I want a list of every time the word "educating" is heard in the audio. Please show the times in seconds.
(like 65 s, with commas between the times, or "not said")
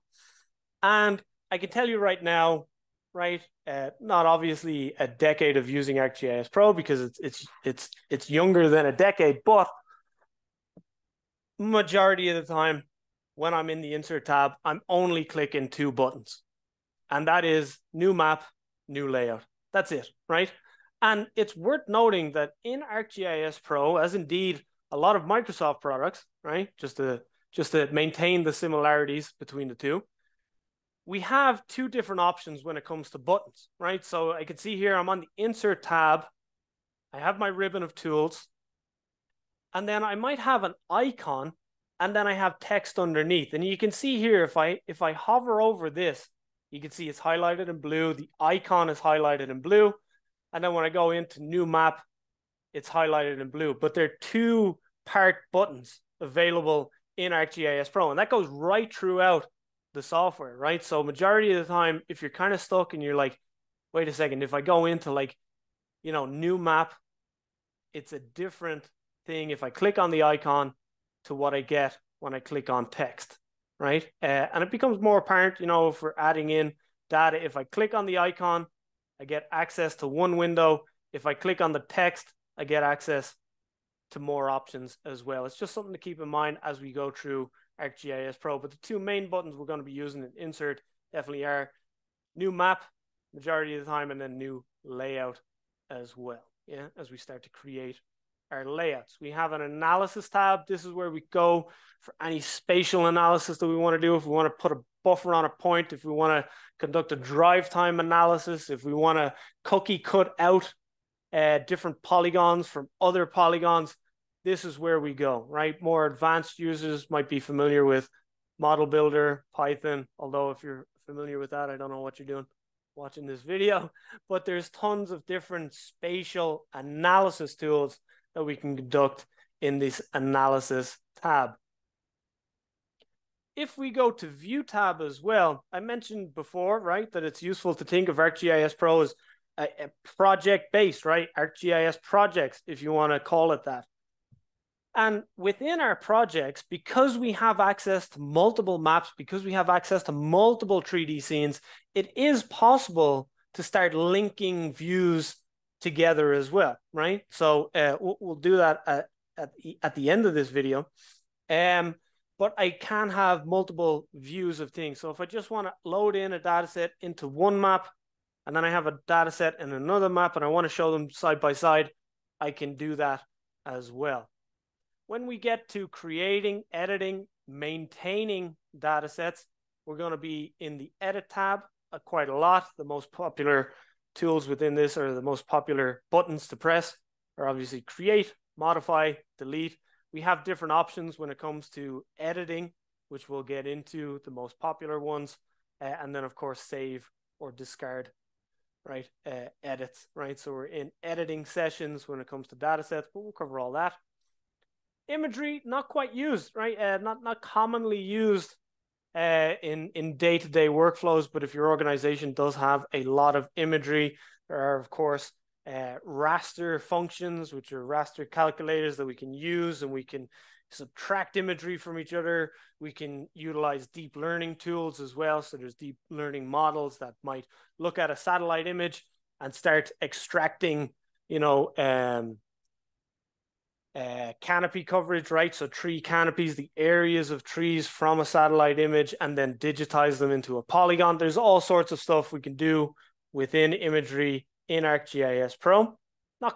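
not said.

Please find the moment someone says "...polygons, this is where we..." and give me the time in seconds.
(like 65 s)
113 s.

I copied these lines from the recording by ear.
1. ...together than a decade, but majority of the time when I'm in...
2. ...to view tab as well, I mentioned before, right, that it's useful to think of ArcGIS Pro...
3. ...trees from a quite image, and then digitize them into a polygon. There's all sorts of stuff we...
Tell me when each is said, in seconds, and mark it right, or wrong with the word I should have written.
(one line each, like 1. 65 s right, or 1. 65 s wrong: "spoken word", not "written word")
1. 8 s wrong: "younger", not "together"
2. 134 s right
3. 237 s wrong: "satellite", not "quite".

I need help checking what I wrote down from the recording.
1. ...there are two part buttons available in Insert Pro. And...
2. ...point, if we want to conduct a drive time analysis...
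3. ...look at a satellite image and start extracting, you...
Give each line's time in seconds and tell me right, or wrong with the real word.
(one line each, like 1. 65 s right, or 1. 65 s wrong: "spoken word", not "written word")
1. 53 s wrong: "ArcGIS", not "Insert"
2. 105 s right
3. 227 s right.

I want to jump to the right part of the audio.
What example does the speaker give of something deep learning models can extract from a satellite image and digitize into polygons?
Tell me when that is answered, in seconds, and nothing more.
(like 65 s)
234 s.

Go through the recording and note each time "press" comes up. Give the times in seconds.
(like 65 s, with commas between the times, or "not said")
186 s.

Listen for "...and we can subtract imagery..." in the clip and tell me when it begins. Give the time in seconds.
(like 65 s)
219 s.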